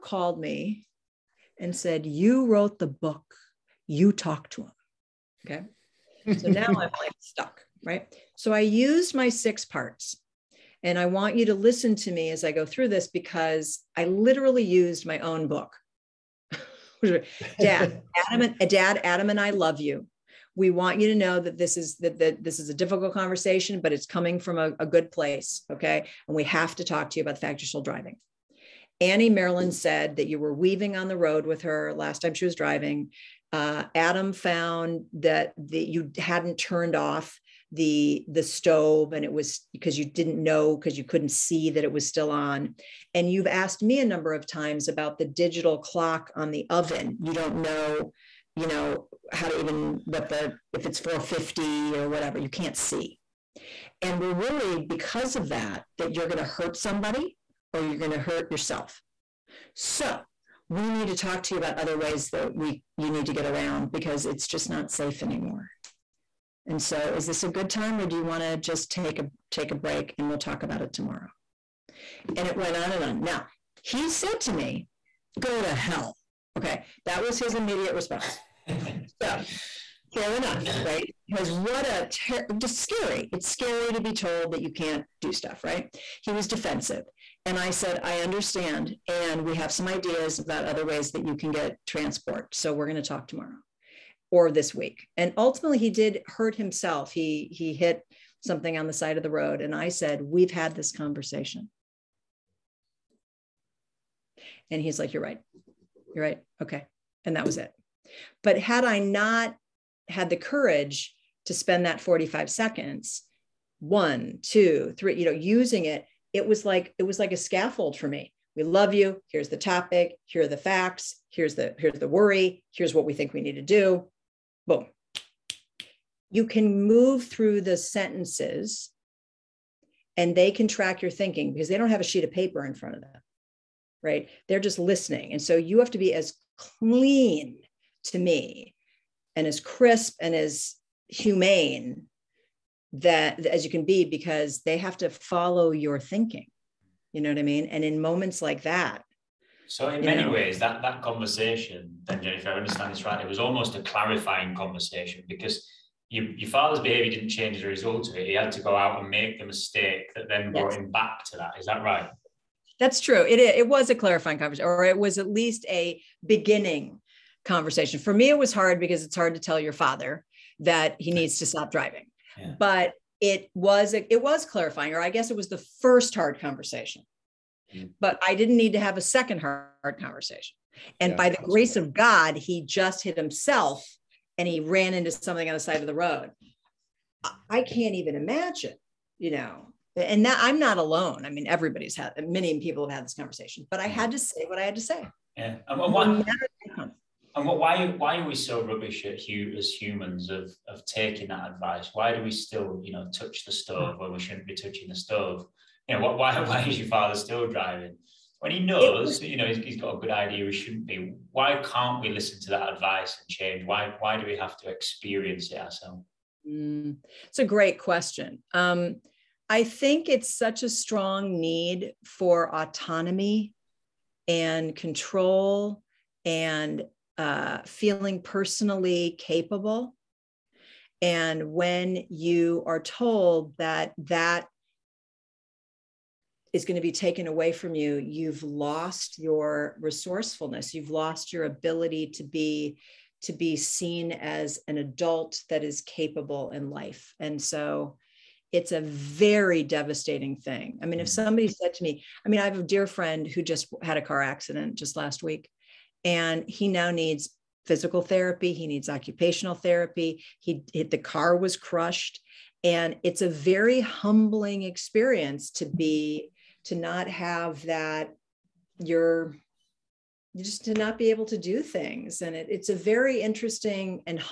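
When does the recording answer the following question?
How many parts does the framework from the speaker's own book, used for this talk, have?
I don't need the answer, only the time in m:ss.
0:09.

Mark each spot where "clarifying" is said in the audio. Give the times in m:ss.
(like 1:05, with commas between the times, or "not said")
2:33, 2:43, 2:54.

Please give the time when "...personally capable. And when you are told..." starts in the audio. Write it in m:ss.
3:48.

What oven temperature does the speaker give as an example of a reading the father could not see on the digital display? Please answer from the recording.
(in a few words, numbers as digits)
450.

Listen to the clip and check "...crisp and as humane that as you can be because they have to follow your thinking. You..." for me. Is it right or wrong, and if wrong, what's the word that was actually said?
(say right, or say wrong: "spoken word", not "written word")
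right.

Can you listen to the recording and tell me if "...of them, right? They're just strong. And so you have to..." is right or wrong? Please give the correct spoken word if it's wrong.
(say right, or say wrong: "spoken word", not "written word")
wrong: "listening", not "strong".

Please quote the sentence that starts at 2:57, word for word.
but I didn't need to have a second hard conversation.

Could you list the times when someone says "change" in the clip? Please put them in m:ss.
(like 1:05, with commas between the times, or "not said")
2:37, 3:33.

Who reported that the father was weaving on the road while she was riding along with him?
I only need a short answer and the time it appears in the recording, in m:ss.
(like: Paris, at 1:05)
Annie Marilyn, at 0:29.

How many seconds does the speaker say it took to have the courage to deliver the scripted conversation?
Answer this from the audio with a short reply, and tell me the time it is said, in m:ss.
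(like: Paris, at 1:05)
45 seconds, at 1:52.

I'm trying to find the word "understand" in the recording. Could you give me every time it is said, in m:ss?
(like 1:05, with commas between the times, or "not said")
1:28, 2:32.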